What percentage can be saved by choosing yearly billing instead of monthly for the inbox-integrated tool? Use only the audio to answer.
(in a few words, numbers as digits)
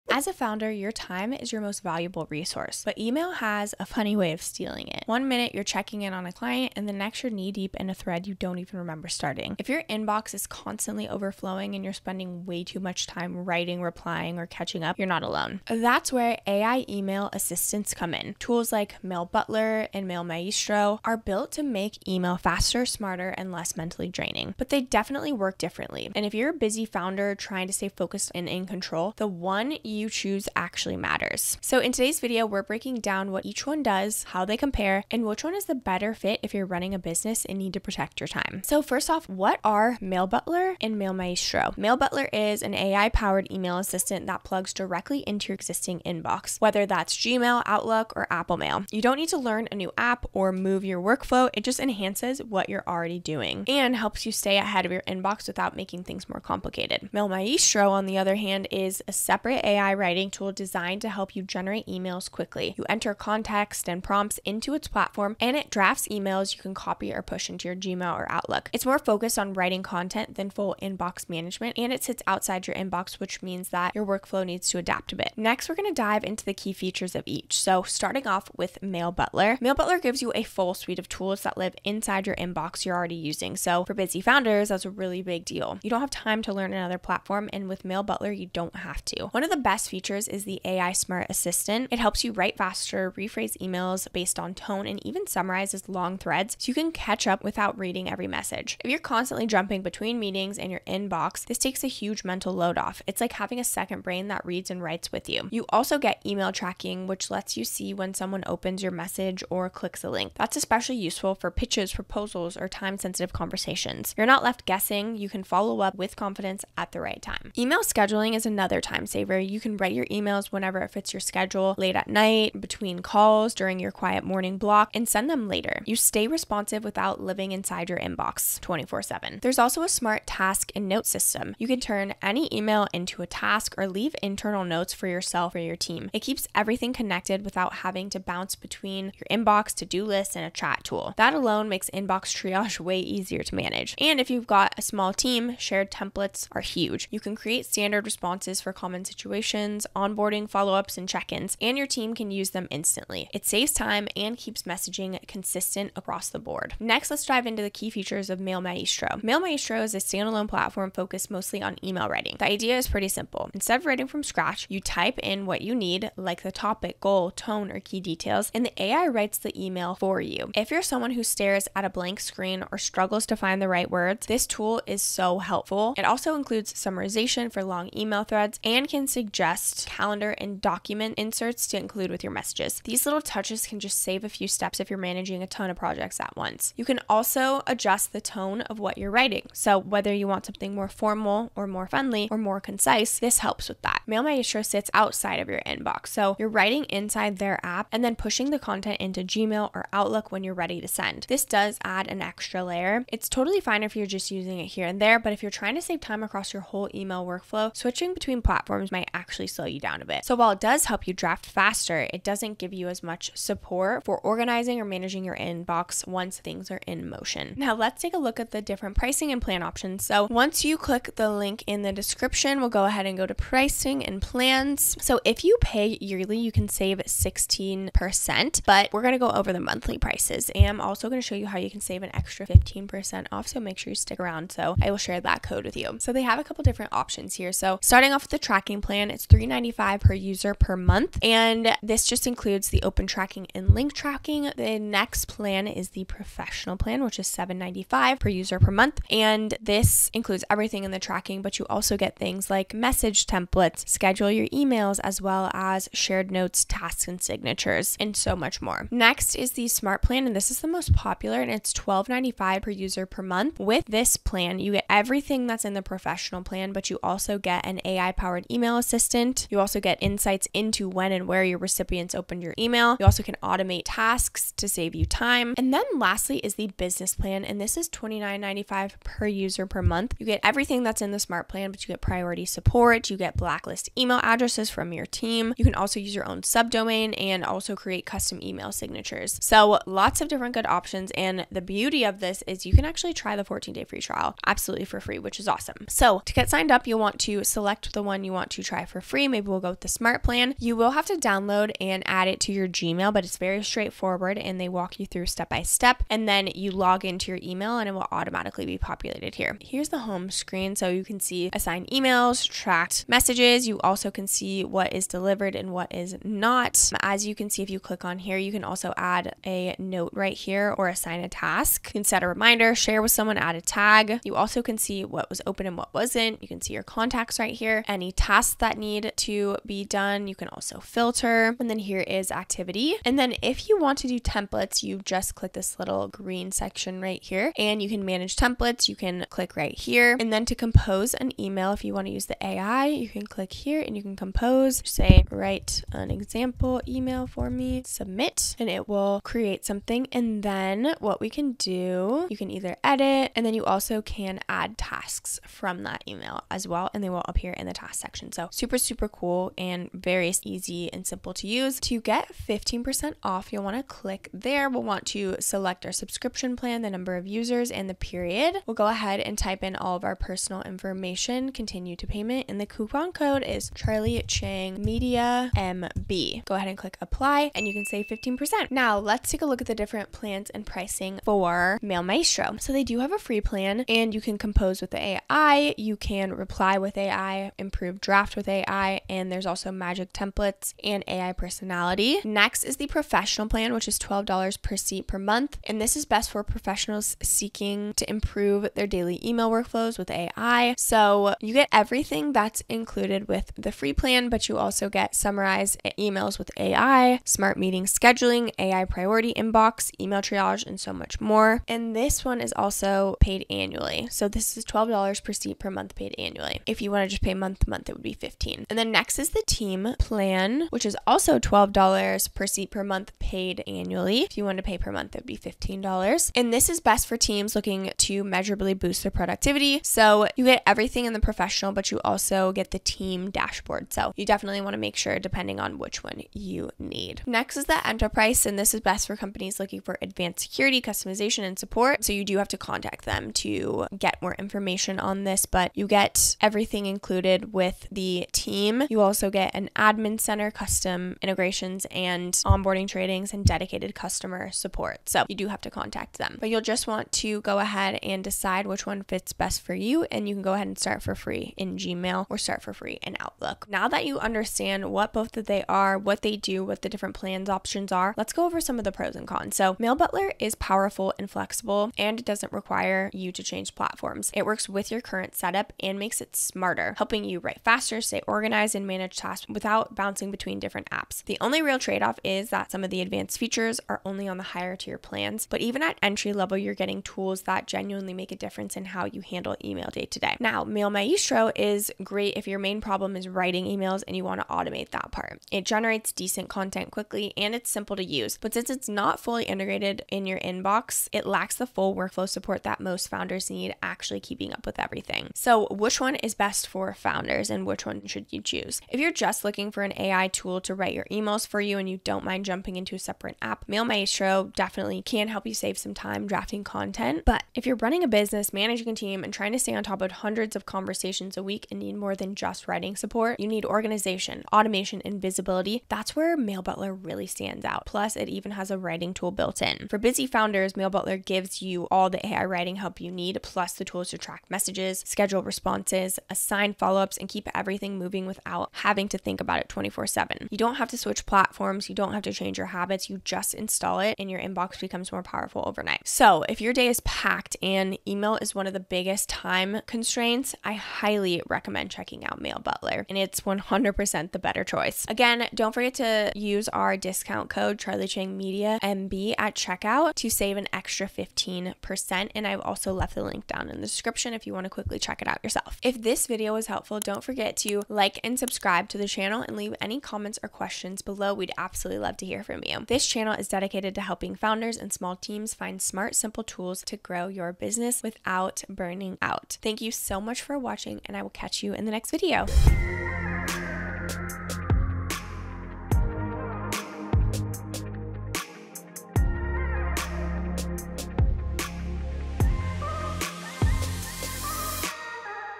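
16%.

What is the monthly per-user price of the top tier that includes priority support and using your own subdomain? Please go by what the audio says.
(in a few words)
$29.95.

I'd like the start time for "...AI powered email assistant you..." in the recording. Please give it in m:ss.
4:27.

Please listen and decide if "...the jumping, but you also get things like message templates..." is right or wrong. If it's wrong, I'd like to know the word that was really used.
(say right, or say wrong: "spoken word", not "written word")
wrong: "tracking", not "jumping".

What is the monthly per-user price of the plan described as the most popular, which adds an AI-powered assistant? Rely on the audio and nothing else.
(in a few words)
$12.95.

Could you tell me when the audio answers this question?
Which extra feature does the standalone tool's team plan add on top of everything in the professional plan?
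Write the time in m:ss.
7:12.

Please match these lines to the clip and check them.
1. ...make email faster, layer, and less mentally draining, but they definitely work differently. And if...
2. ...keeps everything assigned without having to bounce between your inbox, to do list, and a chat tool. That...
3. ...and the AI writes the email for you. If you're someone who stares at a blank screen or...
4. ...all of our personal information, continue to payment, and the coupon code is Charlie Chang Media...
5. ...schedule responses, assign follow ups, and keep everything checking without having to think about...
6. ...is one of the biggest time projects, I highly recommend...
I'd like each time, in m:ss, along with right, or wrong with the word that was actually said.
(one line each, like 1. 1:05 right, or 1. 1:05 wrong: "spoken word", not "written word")
1. 0:21 wrong: "smarter", not "layer"
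2. 2:16 wrong: "connected", not "assigned"
3. 2:48 right
4. 6:09 right
5. 8:55 wrong: "moving", not "checking"
6. 9:08 wrong: "constraints", not "projects".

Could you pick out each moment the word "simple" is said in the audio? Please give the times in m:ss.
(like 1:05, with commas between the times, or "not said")
2:43, 6:01, 8:17, 9:36.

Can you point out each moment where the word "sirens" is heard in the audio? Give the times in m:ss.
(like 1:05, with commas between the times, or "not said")
not said.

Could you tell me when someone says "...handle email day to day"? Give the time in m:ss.
8:09.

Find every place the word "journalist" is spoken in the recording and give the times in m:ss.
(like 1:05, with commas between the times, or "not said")
not said.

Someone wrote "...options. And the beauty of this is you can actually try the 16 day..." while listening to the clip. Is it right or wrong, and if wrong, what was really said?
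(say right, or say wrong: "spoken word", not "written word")
wrong: "14", not "16".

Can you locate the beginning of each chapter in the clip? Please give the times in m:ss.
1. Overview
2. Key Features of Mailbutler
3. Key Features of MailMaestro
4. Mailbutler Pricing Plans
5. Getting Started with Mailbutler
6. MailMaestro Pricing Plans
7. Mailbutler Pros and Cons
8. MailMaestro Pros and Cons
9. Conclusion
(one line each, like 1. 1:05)
1. 0:31
2. 1:17
3. 2:36
4. 3:43
5. 5:00
6. 6:18
7. 7:49
8. 8:10
9. 9:06.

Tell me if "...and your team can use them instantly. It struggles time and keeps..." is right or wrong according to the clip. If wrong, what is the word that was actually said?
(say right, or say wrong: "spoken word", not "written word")
wrong: "saves", not "struggles".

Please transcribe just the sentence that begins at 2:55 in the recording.
It also includes summarization for long email threads and can suggest best calendar and document inserts to include with your messages.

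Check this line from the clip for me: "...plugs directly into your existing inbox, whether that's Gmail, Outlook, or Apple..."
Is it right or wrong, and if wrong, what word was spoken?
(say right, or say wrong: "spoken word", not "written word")
right.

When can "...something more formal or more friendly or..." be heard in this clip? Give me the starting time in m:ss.
3:10.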